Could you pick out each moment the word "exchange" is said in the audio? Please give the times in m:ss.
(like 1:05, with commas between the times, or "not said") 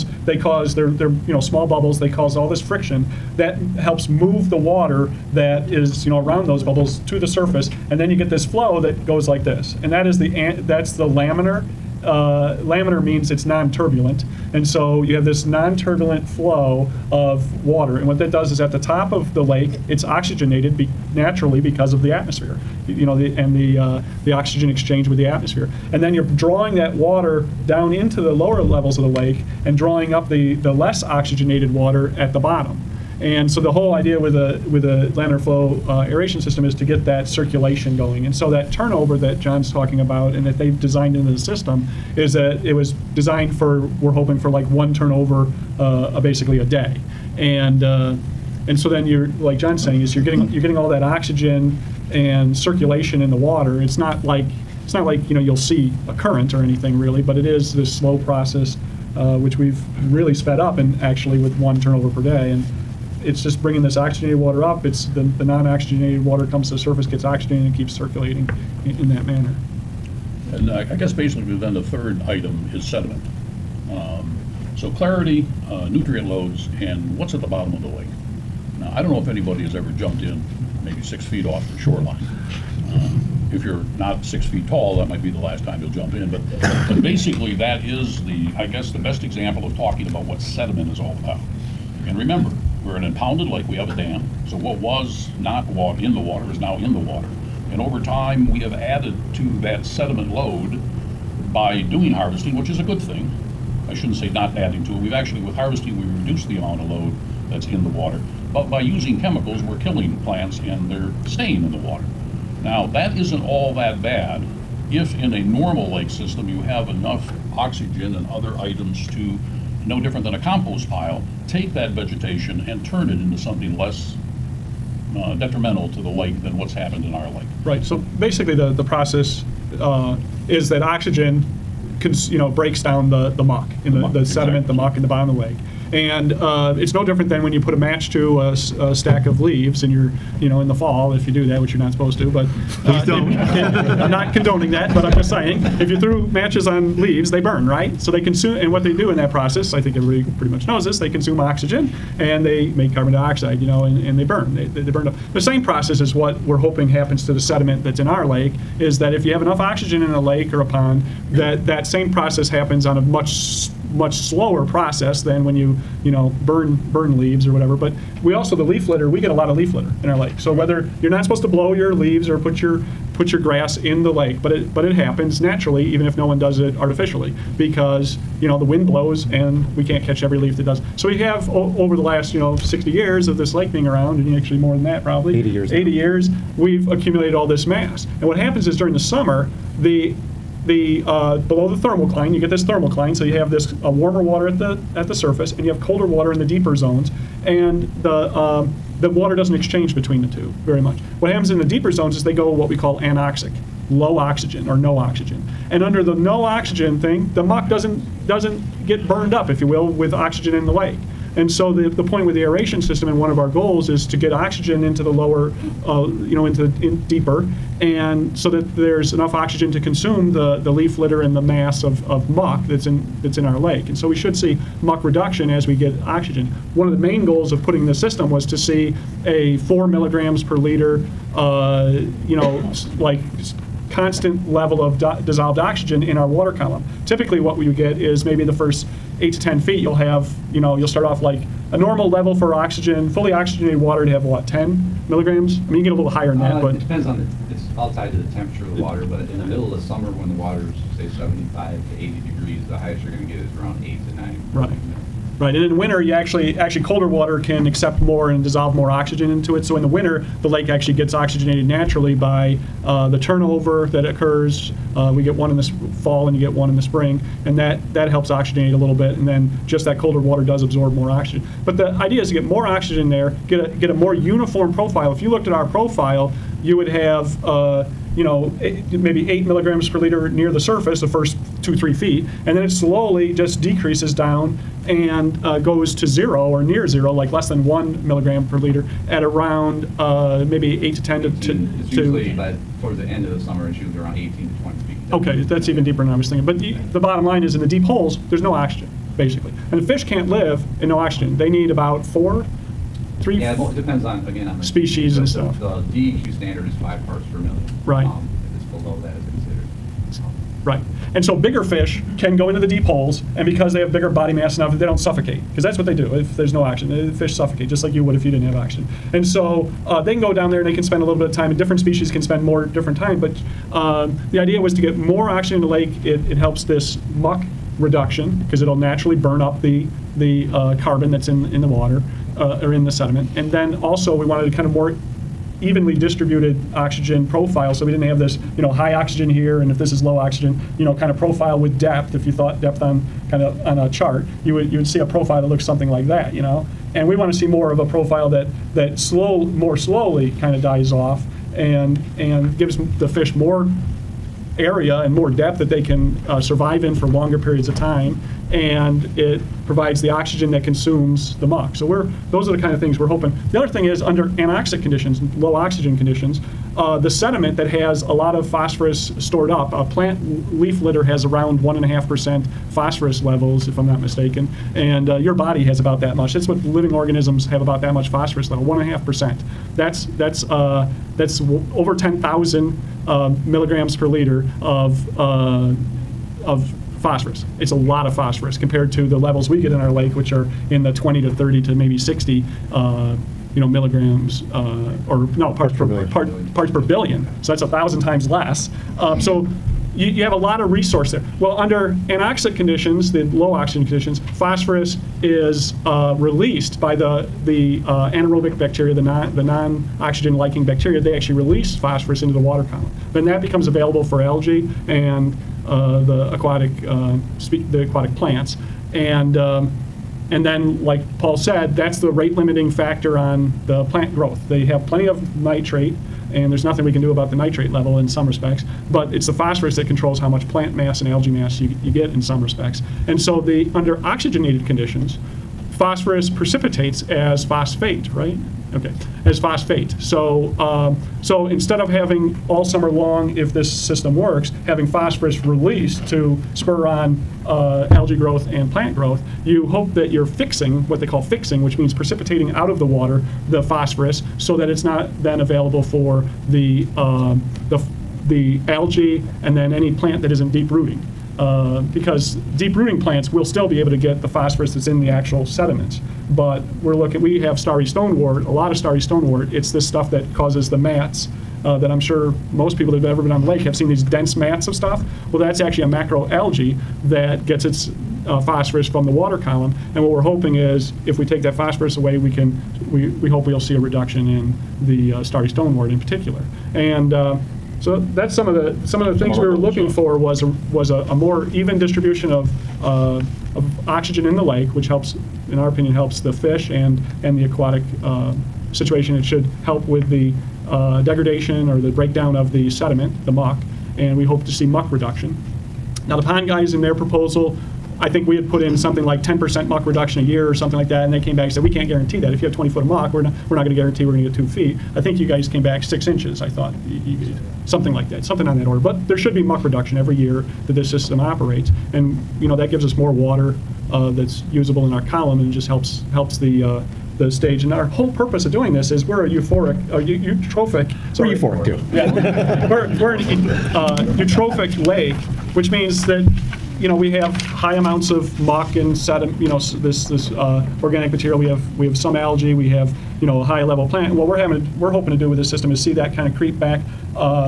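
0:24, 3:19.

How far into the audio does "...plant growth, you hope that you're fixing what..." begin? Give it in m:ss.
7:28.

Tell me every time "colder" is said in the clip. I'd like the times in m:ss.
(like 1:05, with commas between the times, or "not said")
3:15, 4:16, 4:29.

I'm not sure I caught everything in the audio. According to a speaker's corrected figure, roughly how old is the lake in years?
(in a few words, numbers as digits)
80.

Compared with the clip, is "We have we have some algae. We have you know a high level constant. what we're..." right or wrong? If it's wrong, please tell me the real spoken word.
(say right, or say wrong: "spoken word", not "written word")
wrong: "plant", not "constant".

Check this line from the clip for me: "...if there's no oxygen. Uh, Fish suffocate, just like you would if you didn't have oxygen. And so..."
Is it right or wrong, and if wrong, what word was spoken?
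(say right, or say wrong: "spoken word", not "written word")
right.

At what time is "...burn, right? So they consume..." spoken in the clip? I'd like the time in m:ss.
2:27.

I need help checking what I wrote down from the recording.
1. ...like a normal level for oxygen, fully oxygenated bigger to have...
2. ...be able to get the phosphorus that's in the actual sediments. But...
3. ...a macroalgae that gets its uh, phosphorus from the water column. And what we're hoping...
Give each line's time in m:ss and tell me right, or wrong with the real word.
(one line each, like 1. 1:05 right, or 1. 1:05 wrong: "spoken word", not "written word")
1. 4:01 wrong: "water", not "bigger"
2. 7:43 right
3. 7:55 right.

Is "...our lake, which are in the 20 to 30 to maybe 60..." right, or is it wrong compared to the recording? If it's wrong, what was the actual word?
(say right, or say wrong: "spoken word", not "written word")
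right.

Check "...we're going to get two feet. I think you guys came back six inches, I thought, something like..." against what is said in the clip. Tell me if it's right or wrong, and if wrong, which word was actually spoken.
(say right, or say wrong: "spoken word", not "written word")
right.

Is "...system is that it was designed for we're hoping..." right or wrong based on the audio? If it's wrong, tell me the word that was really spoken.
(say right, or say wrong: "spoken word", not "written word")
right.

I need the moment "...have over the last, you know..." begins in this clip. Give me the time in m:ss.
3:01.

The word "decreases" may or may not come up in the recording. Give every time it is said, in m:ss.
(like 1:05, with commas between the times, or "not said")
4:43.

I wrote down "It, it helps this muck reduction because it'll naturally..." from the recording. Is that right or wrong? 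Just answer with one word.
right.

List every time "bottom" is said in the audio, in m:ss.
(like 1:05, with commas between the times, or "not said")
0:32, 1:17, 2:15, 4:56.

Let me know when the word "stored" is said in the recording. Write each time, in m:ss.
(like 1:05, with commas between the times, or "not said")
6:09.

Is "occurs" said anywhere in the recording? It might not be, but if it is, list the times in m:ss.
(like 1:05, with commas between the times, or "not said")
4:24.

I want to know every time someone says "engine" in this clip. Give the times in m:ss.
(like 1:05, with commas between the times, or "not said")
not said.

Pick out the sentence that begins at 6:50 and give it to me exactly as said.
They actually release phosphorus into the water column.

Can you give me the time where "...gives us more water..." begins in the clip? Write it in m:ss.
8:42.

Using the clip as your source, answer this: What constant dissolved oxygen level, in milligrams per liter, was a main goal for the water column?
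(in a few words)
4 milligrams per liter.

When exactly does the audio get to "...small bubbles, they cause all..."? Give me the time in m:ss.
0:01.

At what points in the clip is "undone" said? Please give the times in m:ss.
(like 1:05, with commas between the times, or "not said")
not said.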